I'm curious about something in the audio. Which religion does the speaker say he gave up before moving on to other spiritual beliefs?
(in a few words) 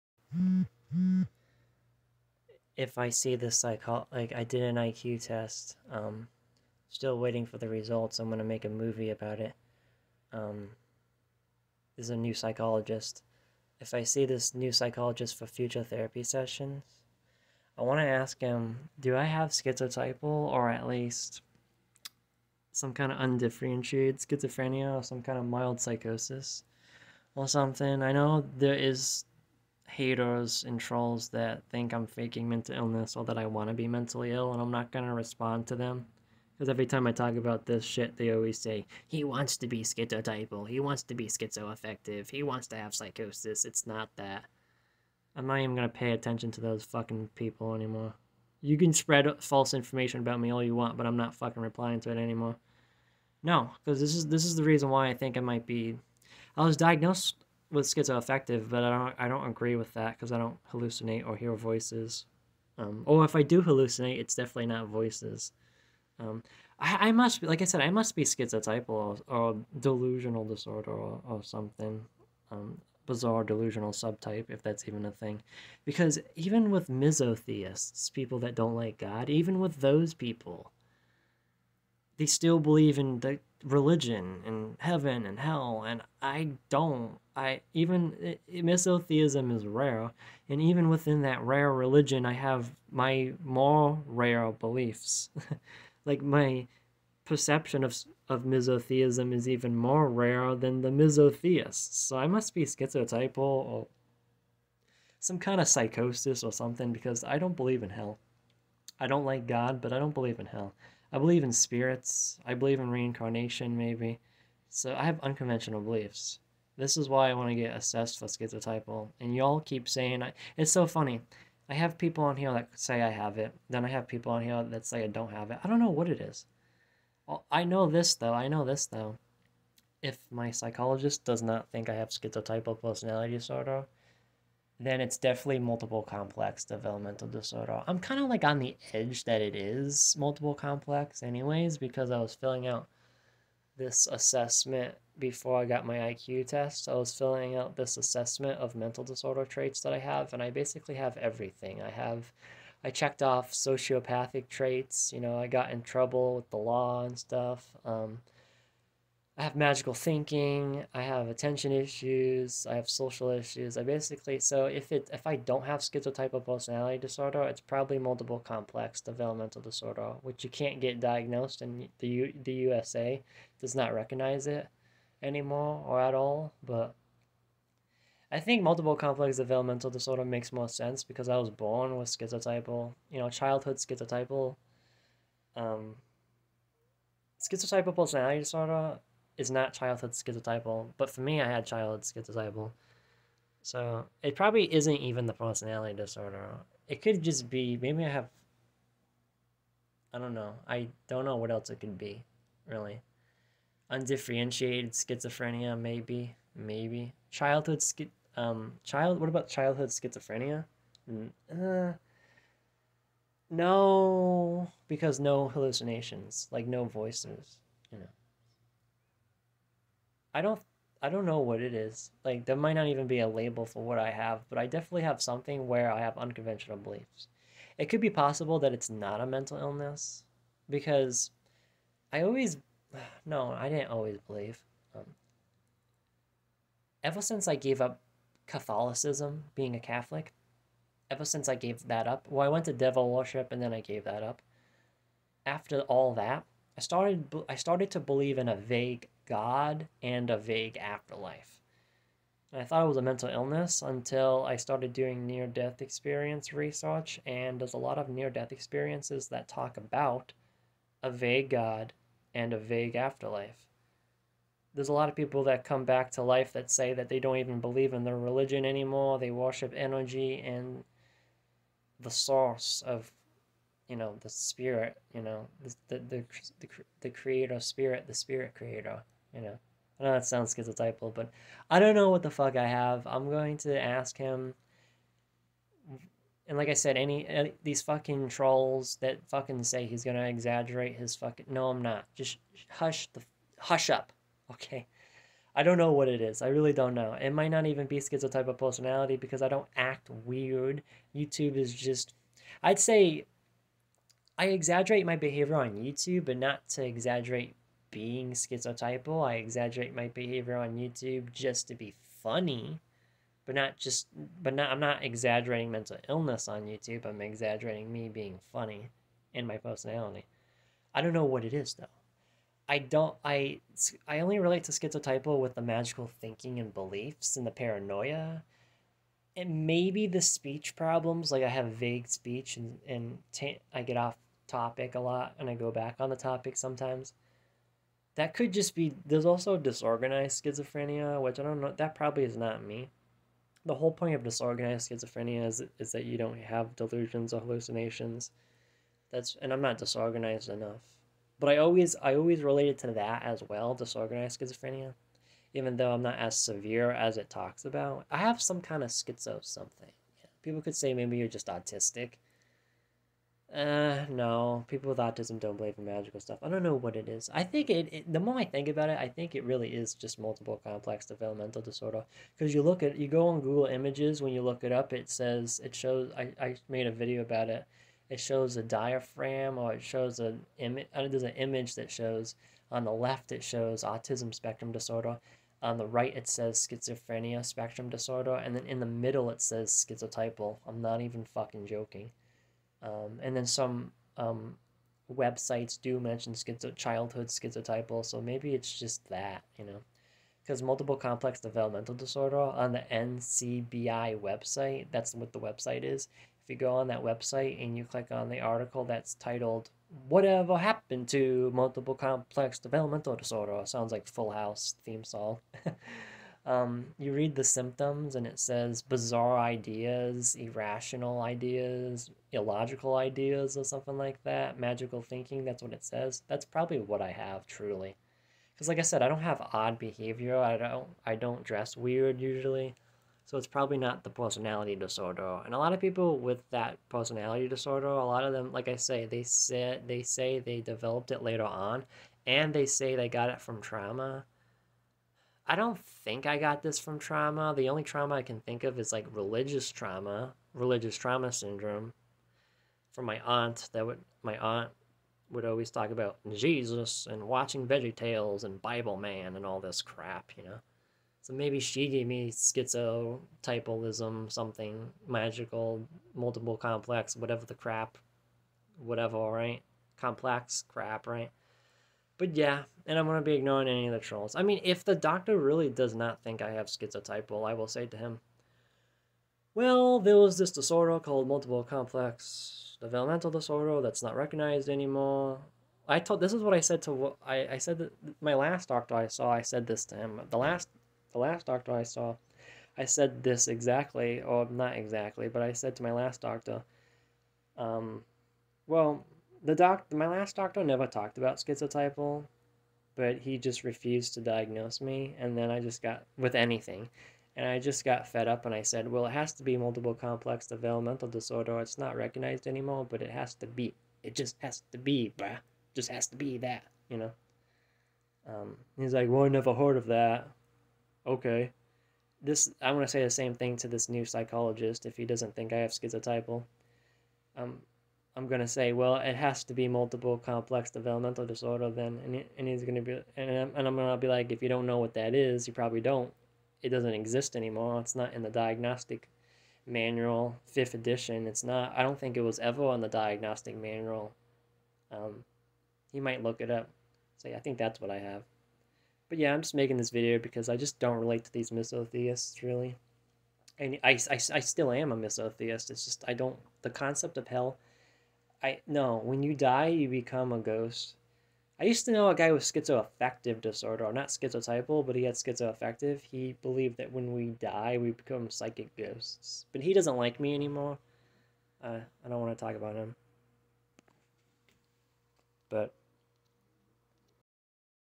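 Catholicism.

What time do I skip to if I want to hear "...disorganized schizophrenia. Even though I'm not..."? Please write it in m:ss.
5:53.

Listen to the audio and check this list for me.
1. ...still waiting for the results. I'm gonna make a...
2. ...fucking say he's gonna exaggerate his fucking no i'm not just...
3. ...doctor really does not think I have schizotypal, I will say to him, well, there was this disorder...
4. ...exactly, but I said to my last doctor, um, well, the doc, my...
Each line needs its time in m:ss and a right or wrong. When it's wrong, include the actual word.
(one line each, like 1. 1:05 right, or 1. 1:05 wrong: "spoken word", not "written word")
1. 0:06 right
2. 4:49 right
3. 7:54 right
4. 8:14 right.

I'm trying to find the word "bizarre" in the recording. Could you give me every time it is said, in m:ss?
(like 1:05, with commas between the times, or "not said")
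1:13, 6:58.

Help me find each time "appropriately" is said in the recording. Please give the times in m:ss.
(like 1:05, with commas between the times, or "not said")
not said.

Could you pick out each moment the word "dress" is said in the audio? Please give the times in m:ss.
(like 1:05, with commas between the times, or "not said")
7:11.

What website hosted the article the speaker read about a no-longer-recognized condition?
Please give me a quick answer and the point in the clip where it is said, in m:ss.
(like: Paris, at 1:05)
NCBI, at 6:42.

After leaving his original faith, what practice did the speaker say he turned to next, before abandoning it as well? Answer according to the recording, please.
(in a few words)
Devil worship.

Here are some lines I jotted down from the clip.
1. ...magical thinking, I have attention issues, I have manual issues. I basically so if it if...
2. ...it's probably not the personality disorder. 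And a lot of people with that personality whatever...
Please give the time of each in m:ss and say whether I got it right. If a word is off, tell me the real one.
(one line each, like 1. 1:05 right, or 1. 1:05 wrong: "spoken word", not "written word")
1. 2:39 wrong: "social", not "manual"
2. 7:13 wrong: "disorder", not "whatever".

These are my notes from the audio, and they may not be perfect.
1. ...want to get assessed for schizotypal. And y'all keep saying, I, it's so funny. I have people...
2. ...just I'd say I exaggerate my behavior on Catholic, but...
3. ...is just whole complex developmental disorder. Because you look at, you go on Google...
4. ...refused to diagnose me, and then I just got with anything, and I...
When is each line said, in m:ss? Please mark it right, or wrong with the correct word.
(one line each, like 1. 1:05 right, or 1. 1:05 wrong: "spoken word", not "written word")
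1. 1:57 right
2. 5:01 wrong: "YouTube", not "Catholic"
3. 6:09 wrong: "multiple", not "whole"
4. 8:23 right.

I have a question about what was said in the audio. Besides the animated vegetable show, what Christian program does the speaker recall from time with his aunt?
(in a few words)
Bible Man.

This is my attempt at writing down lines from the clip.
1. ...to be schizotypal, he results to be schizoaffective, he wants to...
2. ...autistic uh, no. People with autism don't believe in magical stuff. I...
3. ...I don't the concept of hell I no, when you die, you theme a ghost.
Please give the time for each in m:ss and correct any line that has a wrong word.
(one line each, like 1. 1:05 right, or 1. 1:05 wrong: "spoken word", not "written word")
1. 0:39 wrong: "wants", not "results"
2. 6:01 right
3. 9:16 wrong: "become", not "theme".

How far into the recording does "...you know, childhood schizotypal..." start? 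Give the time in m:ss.
3:03.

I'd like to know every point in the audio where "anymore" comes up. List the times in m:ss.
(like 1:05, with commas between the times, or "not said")
0:47, 0:52, 2:55, 4:28, 8:04, 8:32, 8:57, 9:30.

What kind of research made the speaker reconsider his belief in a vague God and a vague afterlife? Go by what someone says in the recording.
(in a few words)
Near death experience research.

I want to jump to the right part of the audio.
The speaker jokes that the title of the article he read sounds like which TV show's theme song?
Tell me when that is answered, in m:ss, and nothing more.
6:54.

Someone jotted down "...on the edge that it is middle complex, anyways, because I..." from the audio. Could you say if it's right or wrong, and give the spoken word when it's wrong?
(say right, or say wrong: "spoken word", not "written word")
wrong: "multiple", not "middle".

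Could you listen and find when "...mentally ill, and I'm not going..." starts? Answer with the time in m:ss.
0:33.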